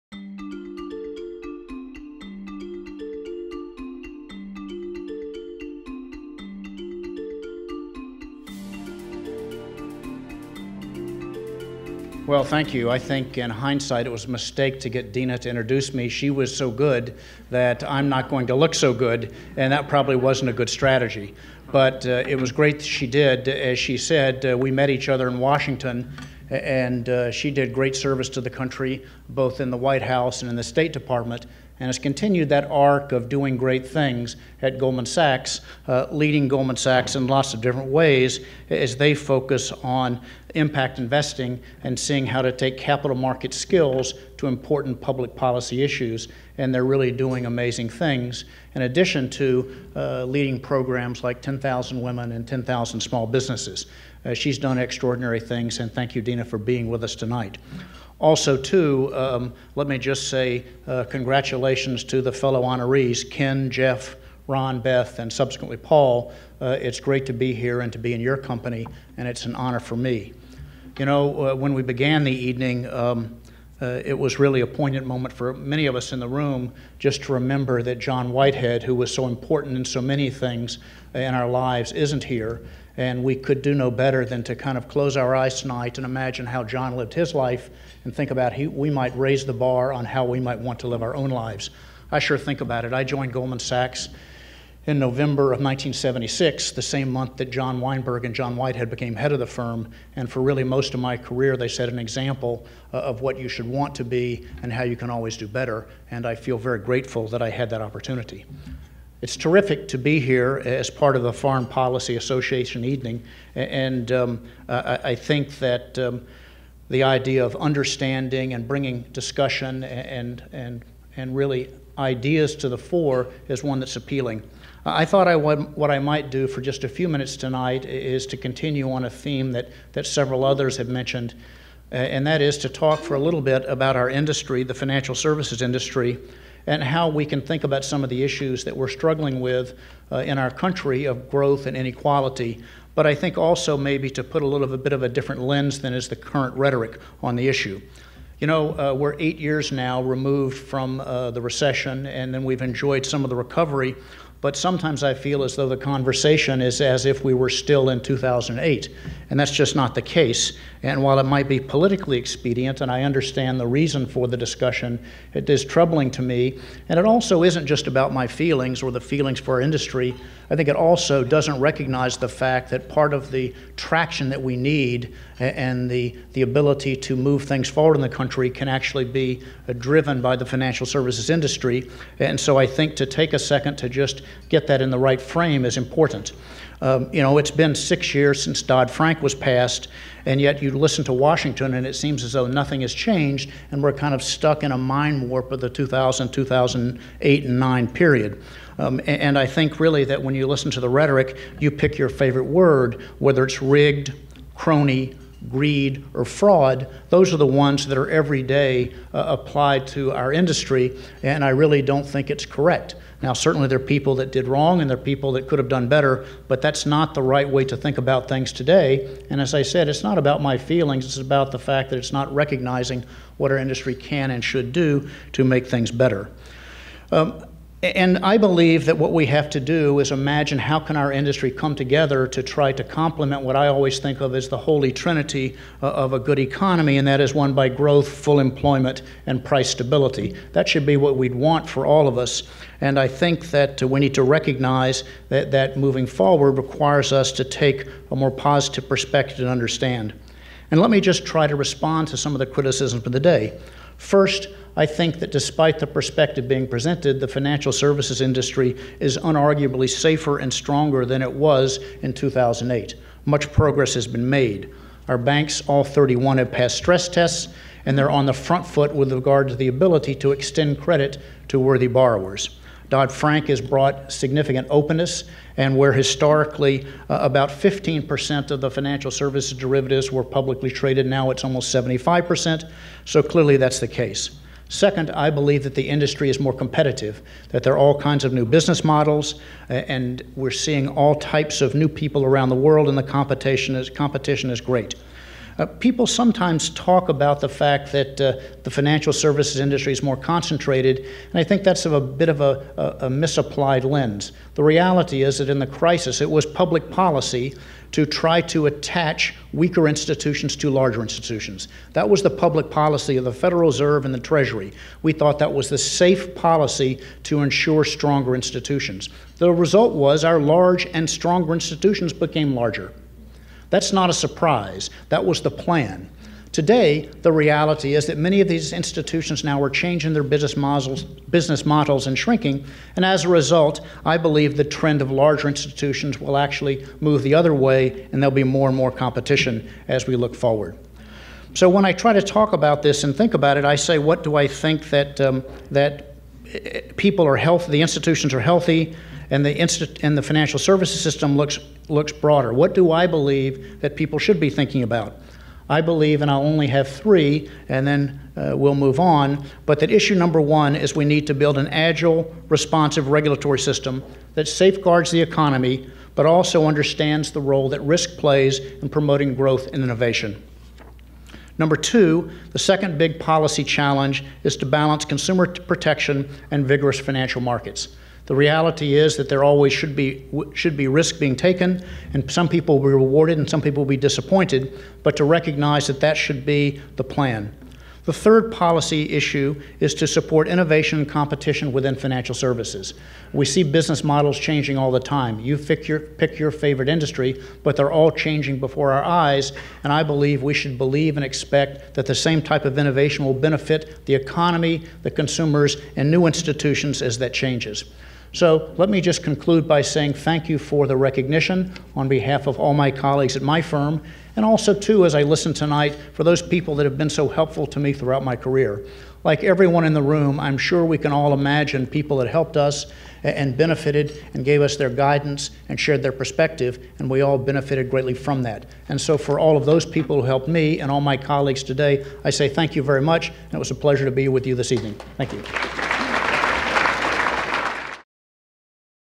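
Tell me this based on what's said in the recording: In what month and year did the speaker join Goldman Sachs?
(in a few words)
November 1976.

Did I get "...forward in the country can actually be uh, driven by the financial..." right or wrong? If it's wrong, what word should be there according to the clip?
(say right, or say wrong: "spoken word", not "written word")
right.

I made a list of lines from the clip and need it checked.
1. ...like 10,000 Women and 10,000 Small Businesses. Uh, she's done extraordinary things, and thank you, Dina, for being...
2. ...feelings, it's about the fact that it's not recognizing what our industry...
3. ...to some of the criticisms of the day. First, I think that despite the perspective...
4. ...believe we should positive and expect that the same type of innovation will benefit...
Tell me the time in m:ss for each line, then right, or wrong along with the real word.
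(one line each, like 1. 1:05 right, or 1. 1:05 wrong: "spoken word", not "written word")
1. 0:51 right
2. 3:40 right
3. 4:12 right
4. 6:40 wrong: "believe", not "positive".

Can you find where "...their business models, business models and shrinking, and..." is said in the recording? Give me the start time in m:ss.
5:30.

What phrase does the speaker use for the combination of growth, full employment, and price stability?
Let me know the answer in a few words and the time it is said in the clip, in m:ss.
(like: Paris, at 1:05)
holy trinity, at 3:54.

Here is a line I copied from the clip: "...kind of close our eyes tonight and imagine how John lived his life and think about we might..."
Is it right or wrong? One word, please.
right.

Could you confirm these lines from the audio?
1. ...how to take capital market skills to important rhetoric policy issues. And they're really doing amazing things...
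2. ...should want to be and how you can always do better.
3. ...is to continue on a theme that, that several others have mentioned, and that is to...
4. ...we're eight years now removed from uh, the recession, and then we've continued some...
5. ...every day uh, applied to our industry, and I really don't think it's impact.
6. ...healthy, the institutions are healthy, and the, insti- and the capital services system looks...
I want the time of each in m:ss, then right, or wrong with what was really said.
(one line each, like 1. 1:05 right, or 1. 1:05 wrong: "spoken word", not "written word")
1. 0:42 wrong: "public", not "rhetoric"
2. 1:43 right
3. 2:07 right
4. 2:28 wrong: "enjoyed", not "continued"
5. 3:28 wrong: "correct", not "impact"
6. 5:47 wrong: "financial", not "capital".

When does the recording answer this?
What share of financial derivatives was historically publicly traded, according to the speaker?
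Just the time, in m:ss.
4:37.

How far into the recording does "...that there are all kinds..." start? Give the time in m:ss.
4:47.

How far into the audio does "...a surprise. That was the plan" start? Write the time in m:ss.
5:24.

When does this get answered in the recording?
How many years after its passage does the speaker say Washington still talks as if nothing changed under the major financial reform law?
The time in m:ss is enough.
3:07.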